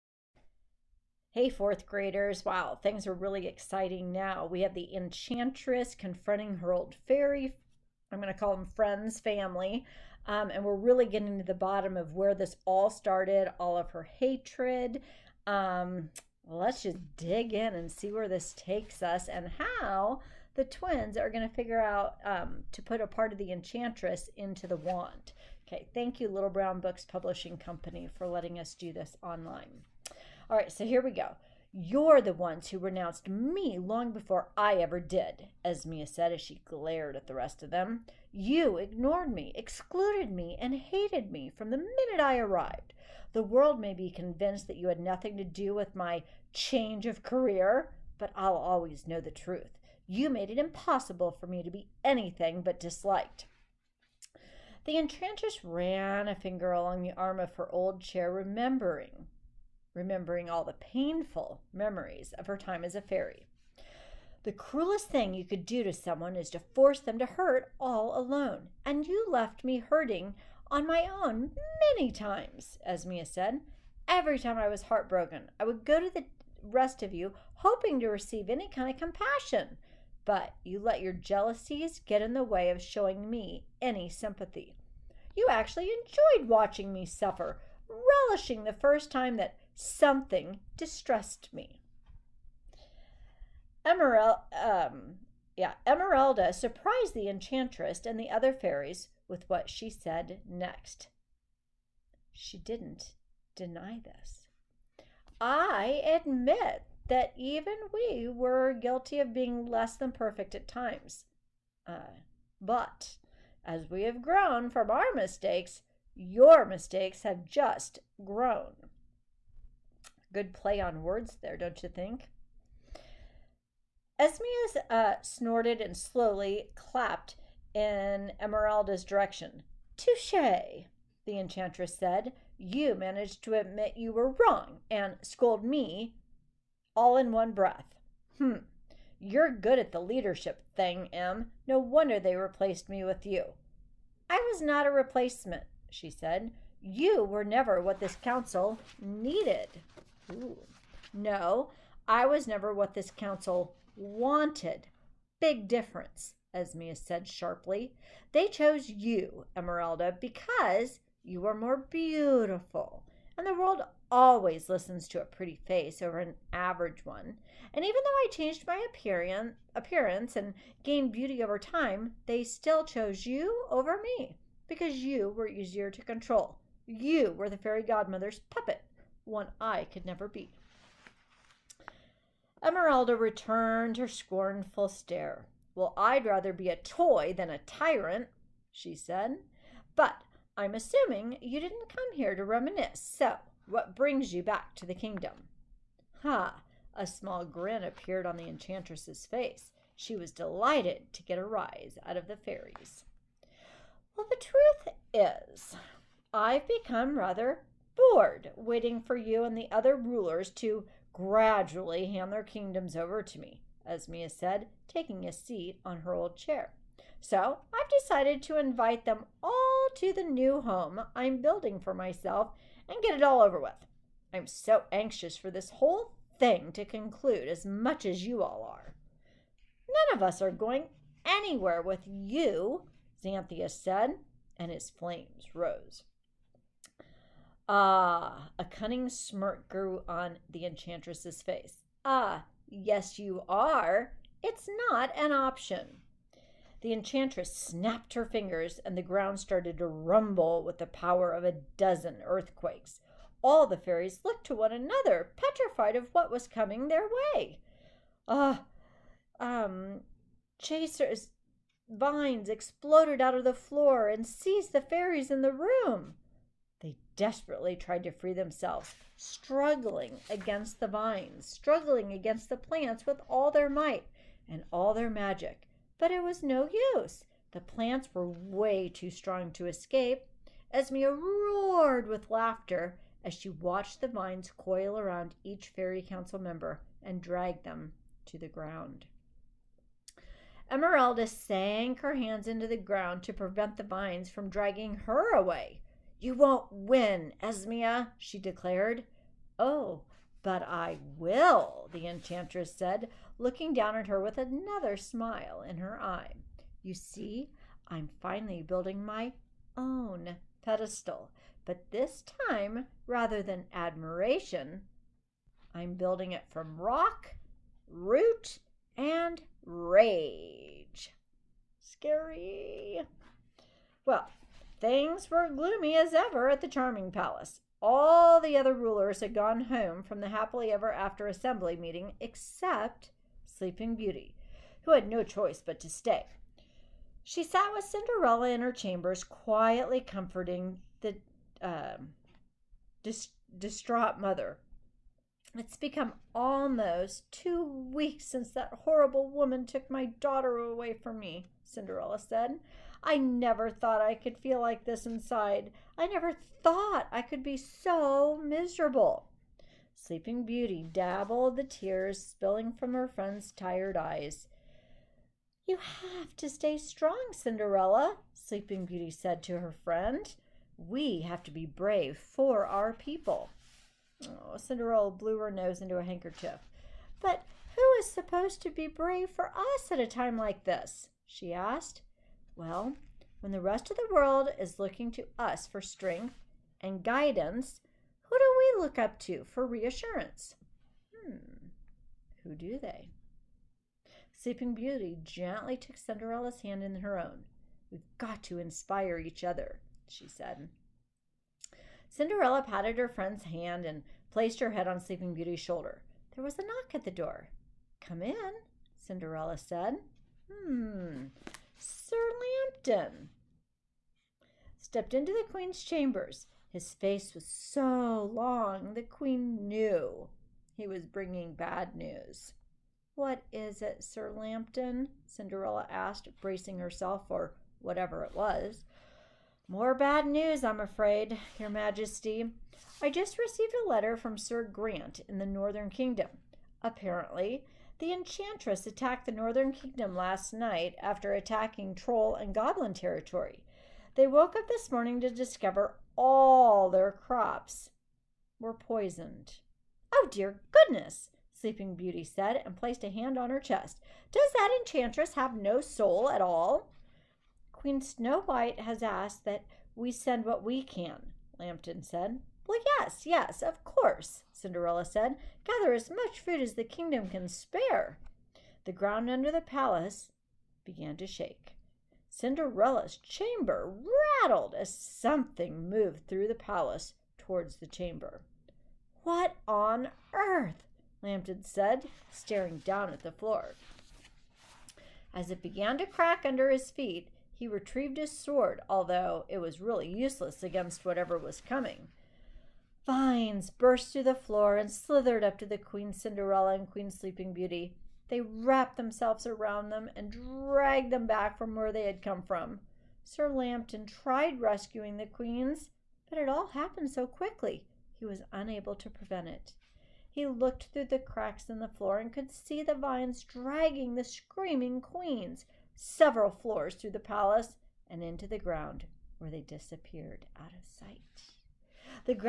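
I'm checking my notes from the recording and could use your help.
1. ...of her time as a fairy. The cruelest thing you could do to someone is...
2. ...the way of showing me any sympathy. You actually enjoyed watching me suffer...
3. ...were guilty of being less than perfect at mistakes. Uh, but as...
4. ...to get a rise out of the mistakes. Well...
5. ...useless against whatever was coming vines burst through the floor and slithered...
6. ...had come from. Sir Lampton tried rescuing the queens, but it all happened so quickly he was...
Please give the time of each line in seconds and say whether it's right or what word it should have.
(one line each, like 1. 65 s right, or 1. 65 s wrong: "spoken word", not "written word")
1. 62 s right
2. 82 s right
3. 108 s wrong: "times", not "mistakes"
4. 201 s wrong: "fairies", not "mistakes"
5. 490 s right
6. 502 s right.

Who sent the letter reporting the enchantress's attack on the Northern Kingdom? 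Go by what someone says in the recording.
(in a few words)
Sir Grant.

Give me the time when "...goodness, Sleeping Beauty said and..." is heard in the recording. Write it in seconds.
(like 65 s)
450 s.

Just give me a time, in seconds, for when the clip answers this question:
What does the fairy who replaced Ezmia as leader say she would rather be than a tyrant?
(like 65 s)
186 s.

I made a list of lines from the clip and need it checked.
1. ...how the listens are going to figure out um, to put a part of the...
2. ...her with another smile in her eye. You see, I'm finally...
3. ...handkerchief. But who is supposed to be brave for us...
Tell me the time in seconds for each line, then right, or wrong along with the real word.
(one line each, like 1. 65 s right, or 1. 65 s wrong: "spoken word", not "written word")
1. 19 s wrong: "twins", not "listens"
2. 304 s right
3. 376 s right.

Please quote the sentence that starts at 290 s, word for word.
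Emerelda sank her hands into the ground to prevent the vines from dragging her away.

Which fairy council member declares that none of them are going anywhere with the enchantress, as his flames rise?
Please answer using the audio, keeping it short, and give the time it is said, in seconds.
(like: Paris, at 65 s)
Xanthia, at 233 s.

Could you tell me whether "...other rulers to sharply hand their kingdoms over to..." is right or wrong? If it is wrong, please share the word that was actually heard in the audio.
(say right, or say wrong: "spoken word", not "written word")
wrong: "gradually", not "sharply".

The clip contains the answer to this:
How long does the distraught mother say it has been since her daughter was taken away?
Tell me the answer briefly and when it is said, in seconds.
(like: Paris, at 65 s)
almost two weeks, at 346 s.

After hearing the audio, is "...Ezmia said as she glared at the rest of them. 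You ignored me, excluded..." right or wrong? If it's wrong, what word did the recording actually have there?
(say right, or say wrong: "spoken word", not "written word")
right.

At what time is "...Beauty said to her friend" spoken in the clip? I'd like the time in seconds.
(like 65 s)
368 s.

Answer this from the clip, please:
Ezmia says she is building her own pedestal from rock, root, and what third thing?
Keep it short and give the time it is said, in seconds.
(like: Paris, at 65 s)
rage, at 319 s.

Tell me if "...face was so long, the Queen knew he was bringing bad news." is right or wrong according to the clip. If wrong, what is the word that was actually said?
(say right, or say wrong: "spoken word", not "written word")
right.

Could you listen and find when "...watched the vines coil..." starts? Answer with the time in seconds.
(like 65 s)
283 s.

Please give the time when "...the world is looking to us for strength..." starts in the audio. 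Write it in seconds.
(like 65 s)
383 s.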